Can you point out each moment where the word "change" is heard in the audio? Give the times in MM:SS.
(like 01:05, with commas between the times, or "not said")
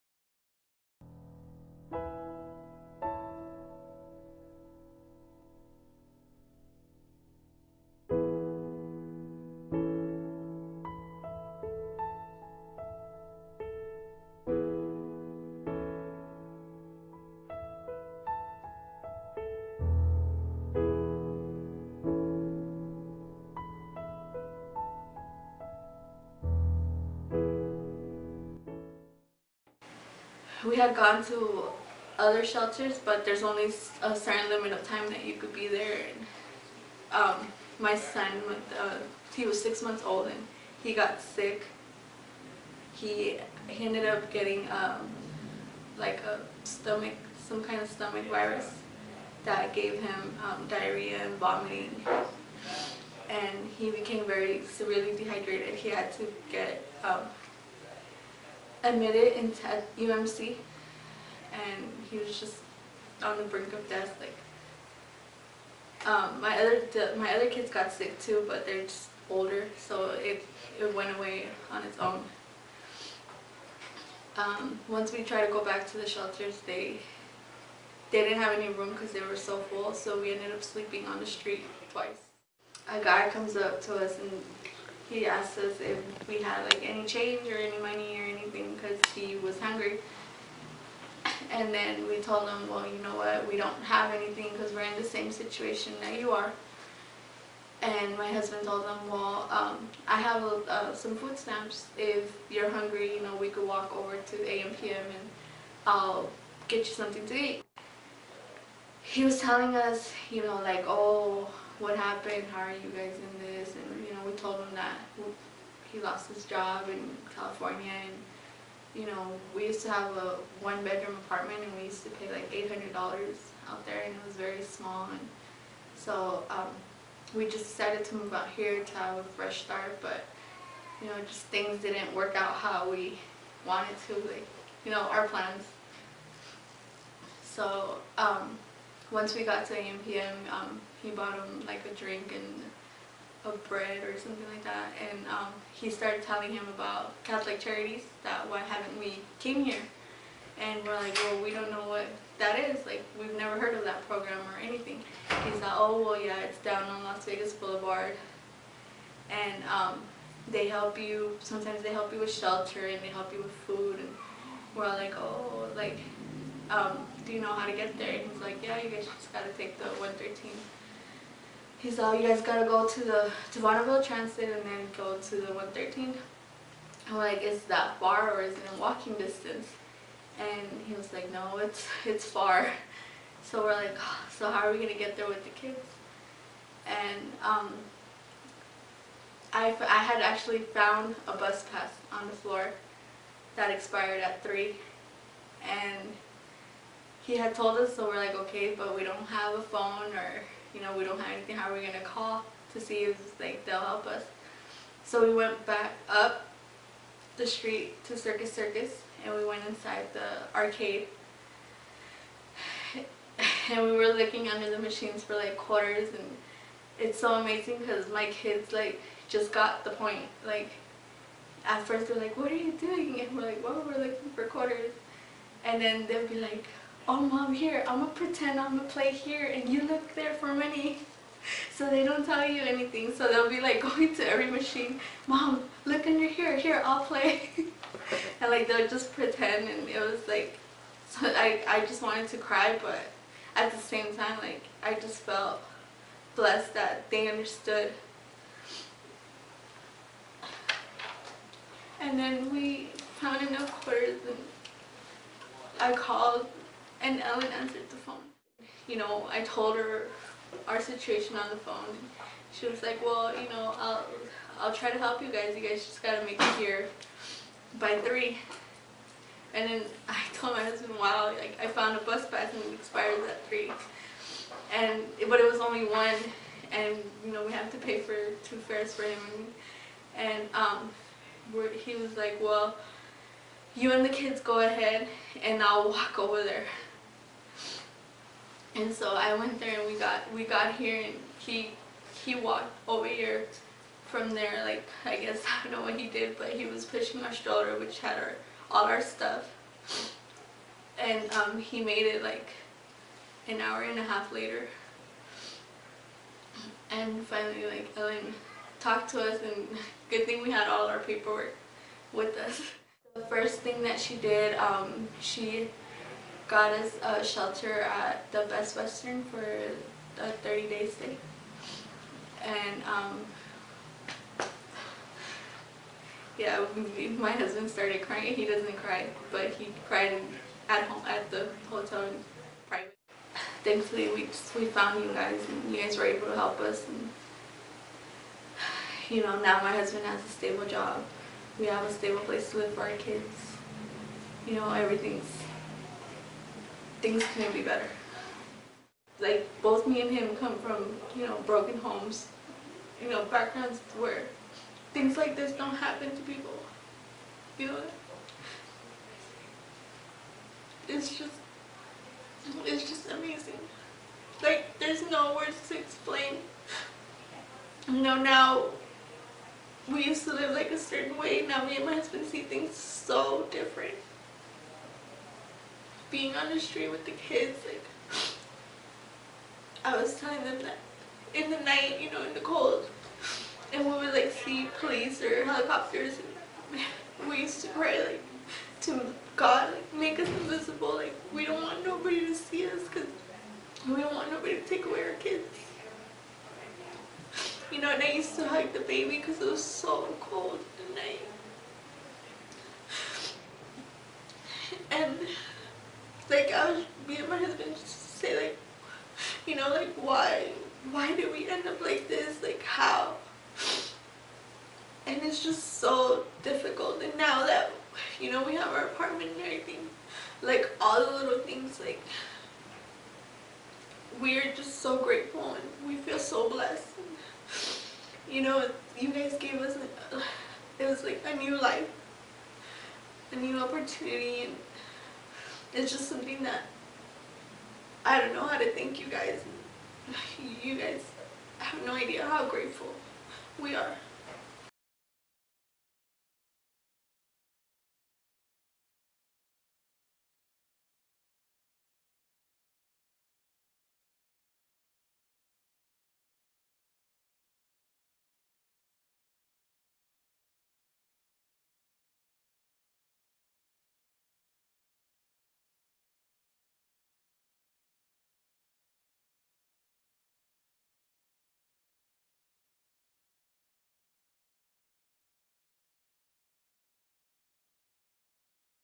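01:27.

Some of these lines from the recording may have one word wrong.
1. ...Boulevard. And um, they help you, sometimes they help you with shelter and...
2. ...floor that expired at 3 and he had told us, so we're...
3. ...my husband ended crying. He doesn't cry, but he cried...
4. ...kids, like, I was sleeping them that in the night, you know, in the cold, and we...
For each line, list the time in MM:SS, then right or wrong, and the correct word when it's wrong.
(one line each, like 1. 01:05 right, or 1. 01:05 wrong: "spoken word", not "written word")
1. 02:37 right
2. 03:12 right
3. 05:27 wrong: "started", not "ended"
4. 06:17 wrong: "telling", not "sleeping".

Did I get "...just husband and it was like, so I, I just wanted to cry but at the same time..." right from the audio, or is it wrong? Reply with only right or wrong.
wrong.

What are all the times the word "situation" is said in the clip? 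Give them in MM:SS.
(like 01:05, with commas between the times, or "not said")
01:35, 04:20.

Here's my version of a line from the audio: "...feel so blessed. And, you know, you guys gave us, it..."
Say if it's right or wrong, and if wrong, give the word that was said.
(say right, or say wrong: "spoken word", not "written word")
right.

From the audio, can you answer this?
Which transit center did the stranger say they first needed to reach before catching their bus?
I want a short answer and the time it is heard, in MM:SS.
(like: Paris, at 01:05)
Bonneville Transit, at 02:53.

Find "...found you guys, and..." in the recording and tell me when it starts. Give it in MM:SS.
05:34.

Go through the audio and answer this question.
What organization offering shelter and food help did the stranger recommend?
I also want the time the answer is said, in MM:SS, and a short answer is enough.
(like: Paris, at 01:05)
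Catholic Charities, at 02:27.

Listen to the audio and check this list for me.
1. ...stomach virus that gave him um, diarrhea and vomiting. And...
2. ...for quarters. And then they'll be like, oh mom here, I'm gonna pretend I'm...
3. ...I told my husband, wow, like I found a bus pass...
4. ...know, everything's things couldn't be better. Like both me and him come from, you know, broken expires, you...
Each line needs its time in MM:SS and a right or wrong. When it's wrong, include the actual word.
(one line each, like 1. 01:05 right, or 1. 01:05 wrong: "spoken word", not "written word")
1. 00:47 right
2. 03:44 right
3. 04:30 right
4. 05:44 wrong: "homes", not "expires".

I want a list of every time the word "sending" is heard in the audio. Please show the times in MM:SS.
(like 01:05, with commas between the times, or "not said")
not said.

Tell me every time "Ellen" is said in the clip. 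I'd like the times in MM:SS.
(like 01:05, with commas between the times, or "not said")
04:17, 05:07.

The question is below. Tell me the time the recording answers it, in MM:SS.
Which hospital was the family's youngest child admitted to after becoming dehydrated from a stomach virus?
00:59.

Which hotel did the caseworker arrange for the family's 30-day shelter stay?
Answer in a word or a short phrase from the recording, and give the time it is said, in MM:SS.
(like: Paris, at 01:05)
Best Western, at 05:18.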